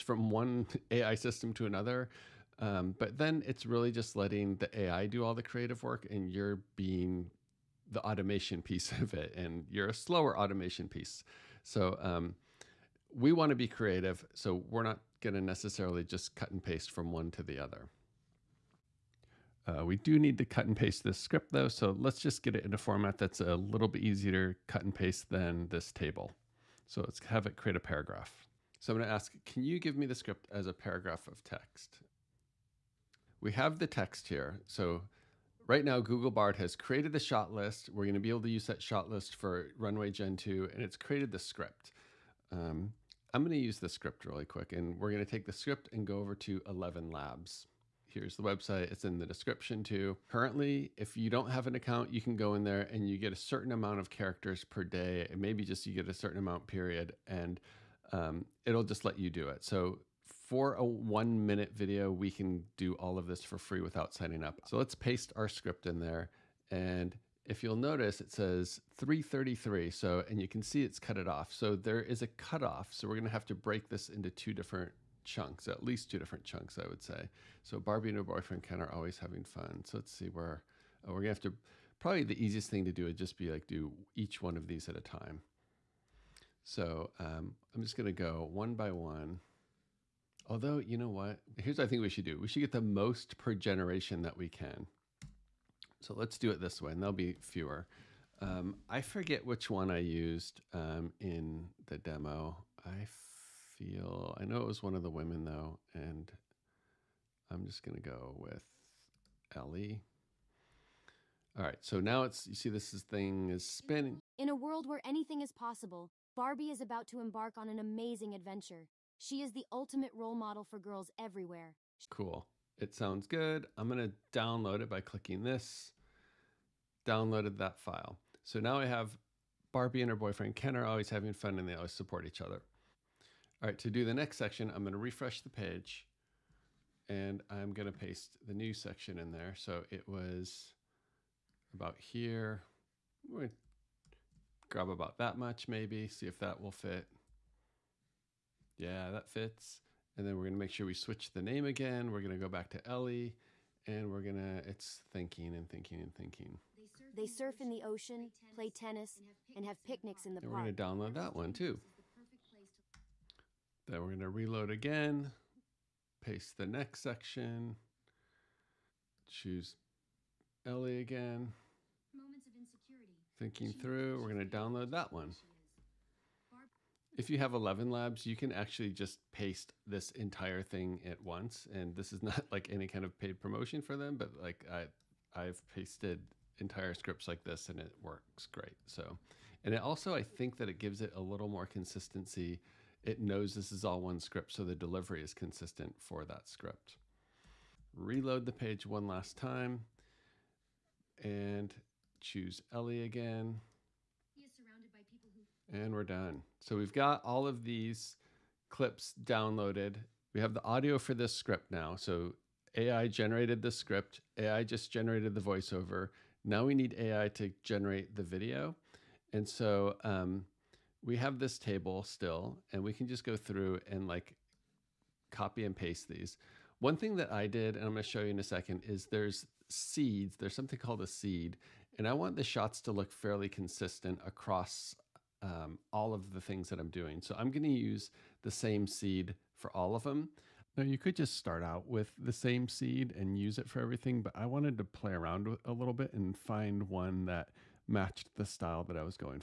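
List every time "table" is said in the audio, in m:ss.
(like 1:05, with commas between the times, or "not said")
0:25, 3:41.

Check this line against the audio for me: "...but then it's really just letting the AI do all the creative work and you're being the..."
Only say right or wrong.
right.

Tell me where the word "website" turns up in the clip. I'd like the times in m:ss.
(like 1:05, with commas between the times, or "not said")
0:48.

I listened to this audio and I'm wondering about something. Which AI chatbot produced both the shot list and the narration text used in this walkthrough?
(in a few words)
Google Bard.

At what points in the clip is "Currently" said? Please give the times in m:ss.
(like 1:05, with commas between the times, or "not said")
0:50.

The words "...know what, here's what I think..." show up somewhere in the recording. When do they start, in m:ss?
1:30.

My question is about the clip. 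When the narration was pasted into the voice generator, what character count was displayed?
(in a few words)
333.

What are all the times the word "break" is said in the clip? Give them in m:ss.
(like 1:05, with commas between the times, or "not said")
1:13.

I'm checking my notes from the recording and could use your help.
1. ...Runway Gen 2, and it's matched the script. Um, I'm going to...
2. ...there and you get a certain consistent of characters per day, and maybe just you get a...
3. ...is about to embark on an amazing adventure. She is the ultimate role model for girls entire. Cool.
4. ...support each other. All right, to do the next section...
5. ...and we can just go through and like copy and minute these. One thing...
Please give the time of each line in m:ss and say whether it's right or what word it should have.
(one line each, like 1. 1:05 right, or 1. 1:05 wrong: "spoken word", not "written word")
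1. 0:39 wrong: "created", not "matched"
2. 0:52 wrong: "amount", not "consistent"
3. 1:56 wrong: "everywhere", not "entire"
4. 2:11 right
5. 3:42 wrong: "paste", not "minute".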